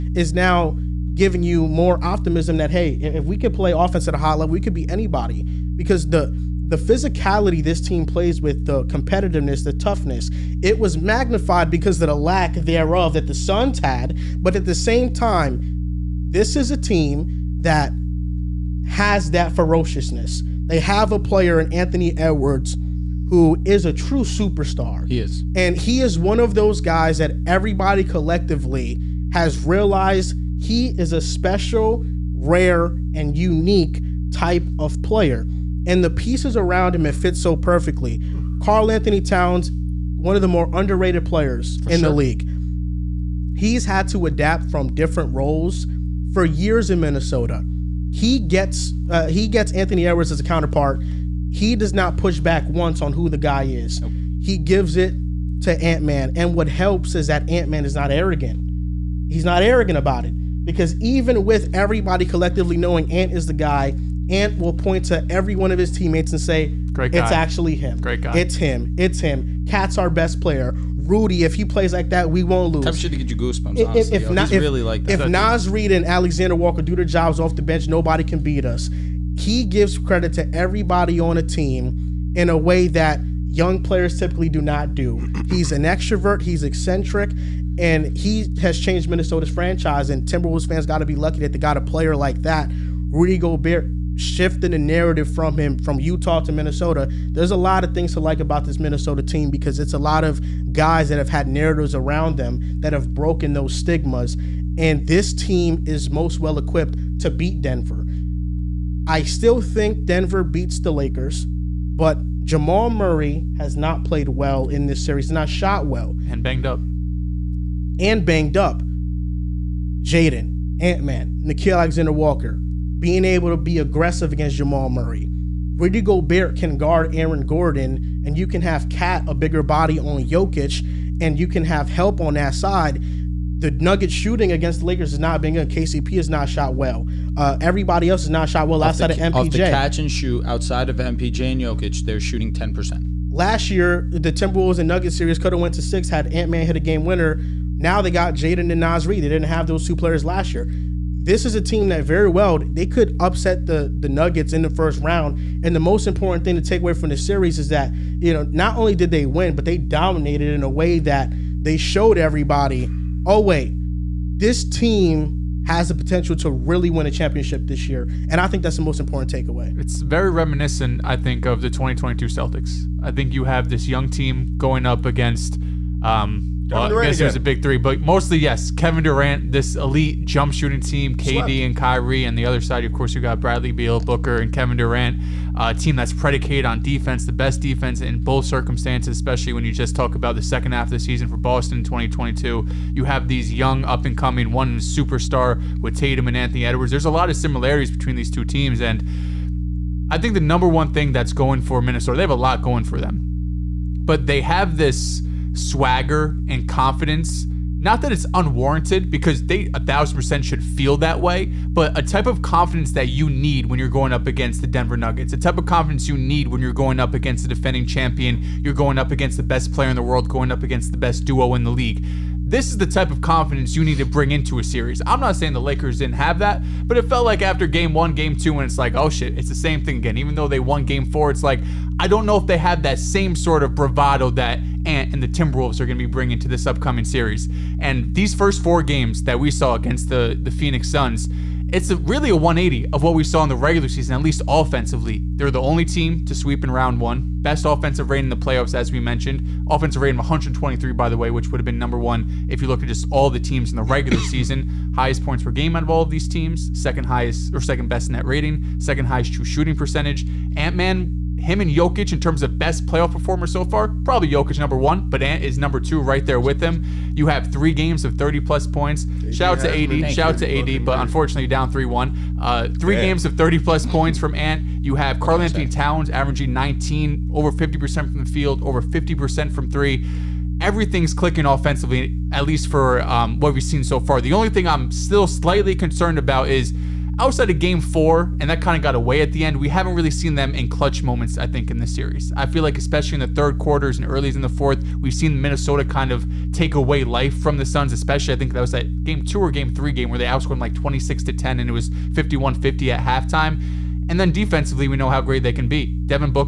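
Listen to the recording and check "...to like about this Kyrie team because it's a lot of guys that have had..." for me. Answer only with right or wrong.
wrong.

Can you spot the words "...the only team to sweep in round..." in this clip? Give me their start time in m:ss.
4:05.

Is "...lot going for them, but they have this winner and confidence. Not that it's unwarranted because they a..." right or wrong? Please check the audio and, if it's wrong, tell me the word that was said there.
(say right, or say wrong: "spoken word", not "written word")
wrong: "swagger", not "winner".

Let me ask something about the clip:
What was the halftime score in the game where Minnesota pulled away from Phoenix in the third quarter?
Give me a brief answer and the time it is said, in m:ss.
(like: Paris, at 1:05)
51-50, at 5:02.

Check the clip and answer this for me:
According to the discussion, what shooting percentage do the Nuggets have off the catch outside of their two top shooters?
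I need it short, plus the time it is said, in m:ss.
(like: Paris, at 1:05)
10%, at 2:22.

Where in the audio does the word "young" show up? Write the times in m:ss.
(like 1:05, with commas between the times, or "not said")
1:23, 2:53, 3:13.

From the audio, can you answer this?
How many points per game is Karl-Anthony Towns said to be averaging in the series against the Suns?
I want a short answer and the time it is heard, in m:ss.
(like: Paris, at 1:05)
19, at 4:36.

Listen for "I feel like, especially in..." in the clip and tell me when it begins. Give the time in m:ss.
4:52.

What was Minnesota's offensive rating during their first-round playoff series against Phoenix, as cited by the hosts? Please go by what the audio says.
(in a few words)
123.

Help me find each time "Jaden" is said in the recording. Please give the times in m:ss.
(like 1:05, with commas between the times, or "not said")
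2:00, 2:28.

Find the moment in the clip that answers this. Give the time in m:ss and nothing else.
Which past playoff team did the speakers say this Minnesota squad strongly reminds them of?
2:51.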